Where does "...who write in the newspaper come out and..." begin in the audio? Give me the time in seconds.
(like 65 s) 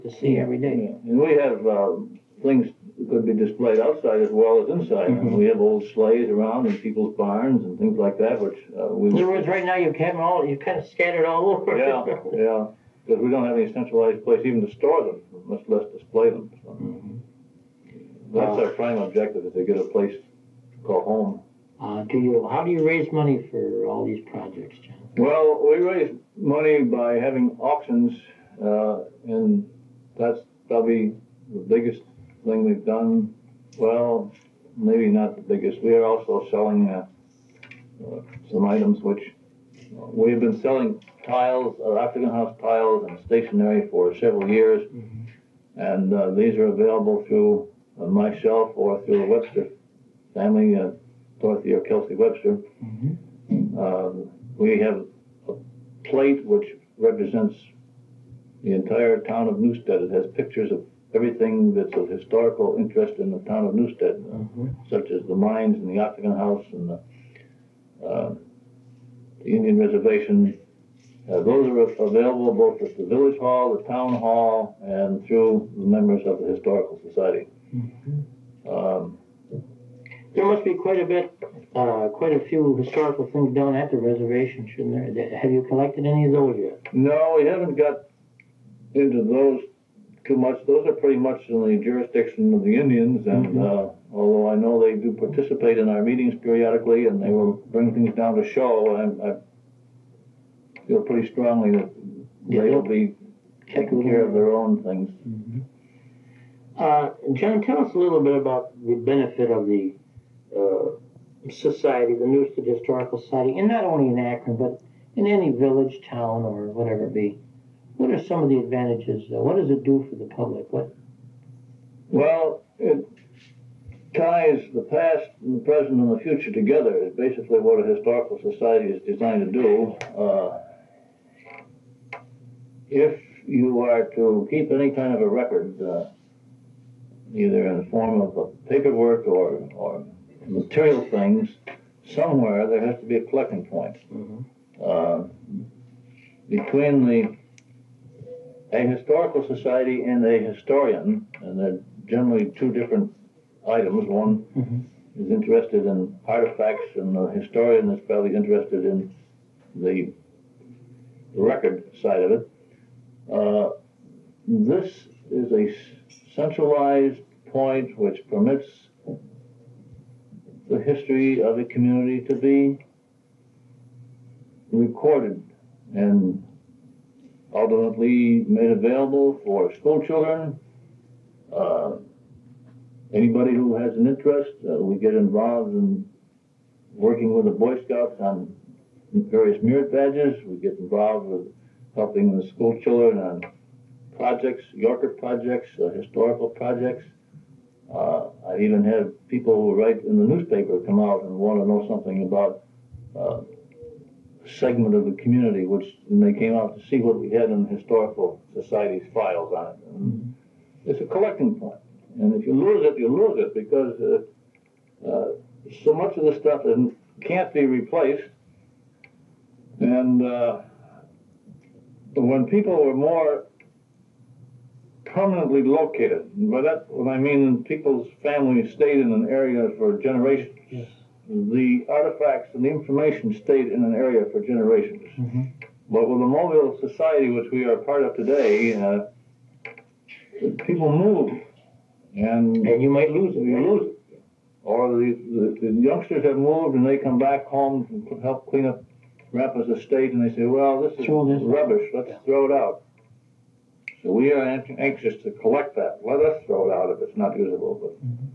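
199 s.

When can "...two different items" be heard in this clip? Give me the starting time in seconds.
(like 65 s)
152 s.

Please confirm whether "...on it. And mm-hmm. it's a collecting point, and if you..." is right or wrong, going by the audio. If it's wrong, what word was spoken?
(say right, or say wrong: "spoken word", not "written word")
right.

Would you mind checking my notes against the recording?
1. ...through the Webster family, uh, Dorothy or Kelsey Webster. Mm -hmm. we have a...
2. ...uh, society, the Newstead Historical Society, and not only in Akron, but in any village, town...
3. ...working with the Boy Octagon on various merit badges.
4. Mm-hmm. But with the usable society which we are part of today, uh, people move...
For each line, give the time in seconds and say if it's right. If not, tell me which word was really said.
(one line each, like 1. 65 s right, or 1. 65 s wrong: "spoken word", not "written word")
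1. 49 s right
2. 110 s right
3. 186 s wrong: "Scouts", not "Octagon"
4. 235 s wrong: "mobile", not "usable".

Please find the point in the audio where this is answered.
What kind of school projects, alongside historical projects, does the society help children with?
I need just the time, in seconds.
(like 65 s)
194 s.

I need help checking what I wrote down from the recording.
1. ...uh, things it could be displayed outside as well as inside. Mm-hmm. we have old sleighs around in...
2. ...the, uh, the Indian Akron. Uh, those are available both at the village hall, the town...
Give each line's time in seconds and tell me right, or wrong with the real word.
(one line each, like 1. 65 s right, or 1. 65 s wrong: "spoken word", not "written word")
1. 1 s right
2. 66 s wrong: "Reservation", not "Akron".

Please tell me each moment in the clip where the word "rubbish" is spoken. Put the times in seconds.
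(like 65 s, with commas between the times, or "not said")
251 s.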